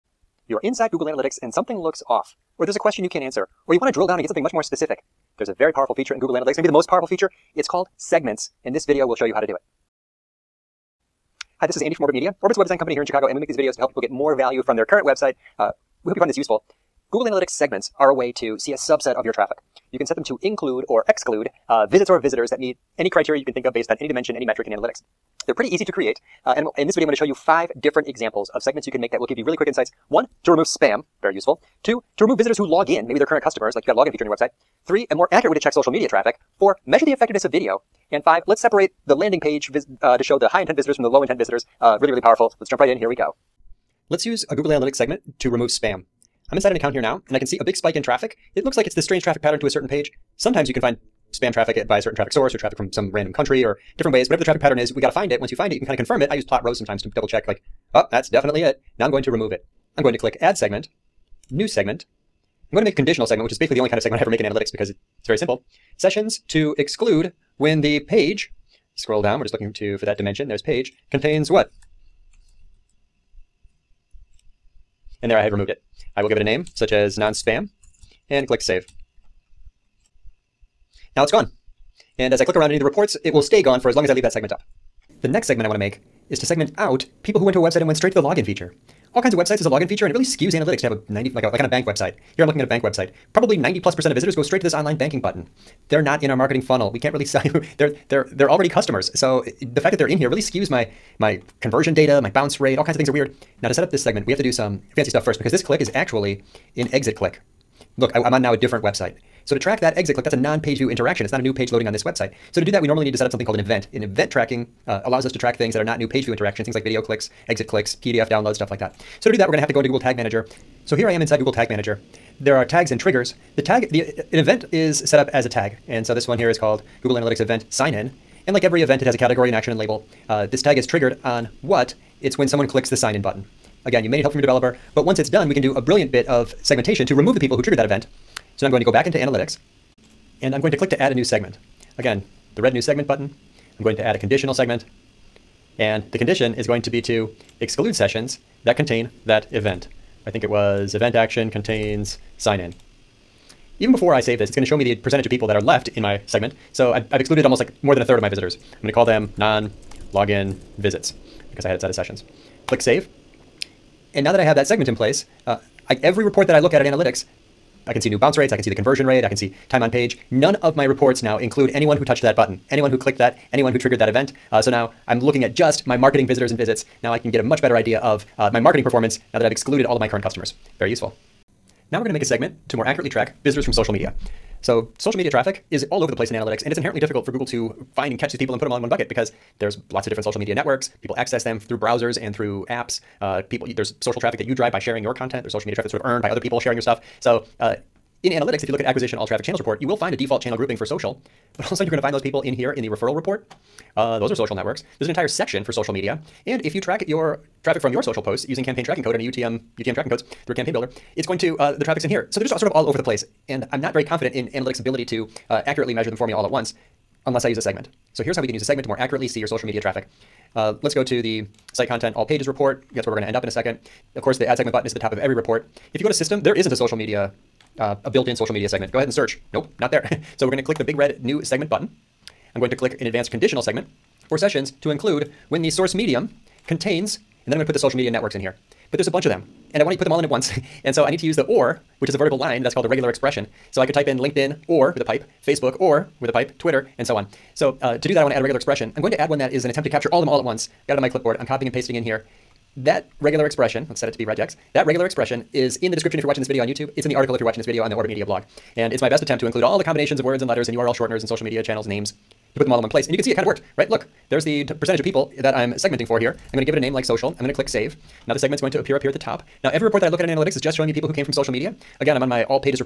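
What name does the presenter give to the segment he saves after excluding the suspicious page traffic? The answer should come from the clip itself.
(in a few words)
non-spam.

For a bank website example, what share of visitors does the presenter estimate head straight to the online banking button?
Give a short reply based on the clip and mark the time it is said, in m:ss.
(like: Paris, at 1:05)
90 plus percent, at 1:33.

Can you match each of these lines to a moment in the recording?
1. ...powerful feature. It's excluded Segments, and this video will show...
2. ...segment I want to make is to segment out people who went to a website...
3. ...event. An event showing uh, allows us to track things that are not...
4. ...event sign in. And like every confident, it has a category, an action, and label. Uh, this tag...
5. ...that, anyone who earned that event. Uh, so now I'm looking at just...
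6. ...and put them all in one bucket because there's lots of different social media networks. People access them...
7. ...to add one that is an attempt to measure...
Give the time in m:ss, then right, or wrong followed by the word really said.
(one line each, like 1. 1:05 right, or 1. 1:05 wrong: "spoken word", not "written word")
1. 0:06 wrong: "called", not "excluded"
2. 1:25 right
3. 1:53 wrong: "tracking", not "showing"
4. 2:07 wrong: "event", not "confident"
5. 2:53 wrong: "triggered", not "earned"
6. 3:08 right
7. 4:09 wrong: "capture", not "measure".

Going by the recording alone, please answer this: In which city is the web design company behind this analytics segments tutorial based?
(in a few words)
Chicago.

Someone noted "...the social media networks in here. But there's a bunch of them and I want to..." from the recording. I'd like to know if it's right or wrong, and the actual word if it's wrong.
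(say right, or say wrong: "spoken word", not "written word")
right.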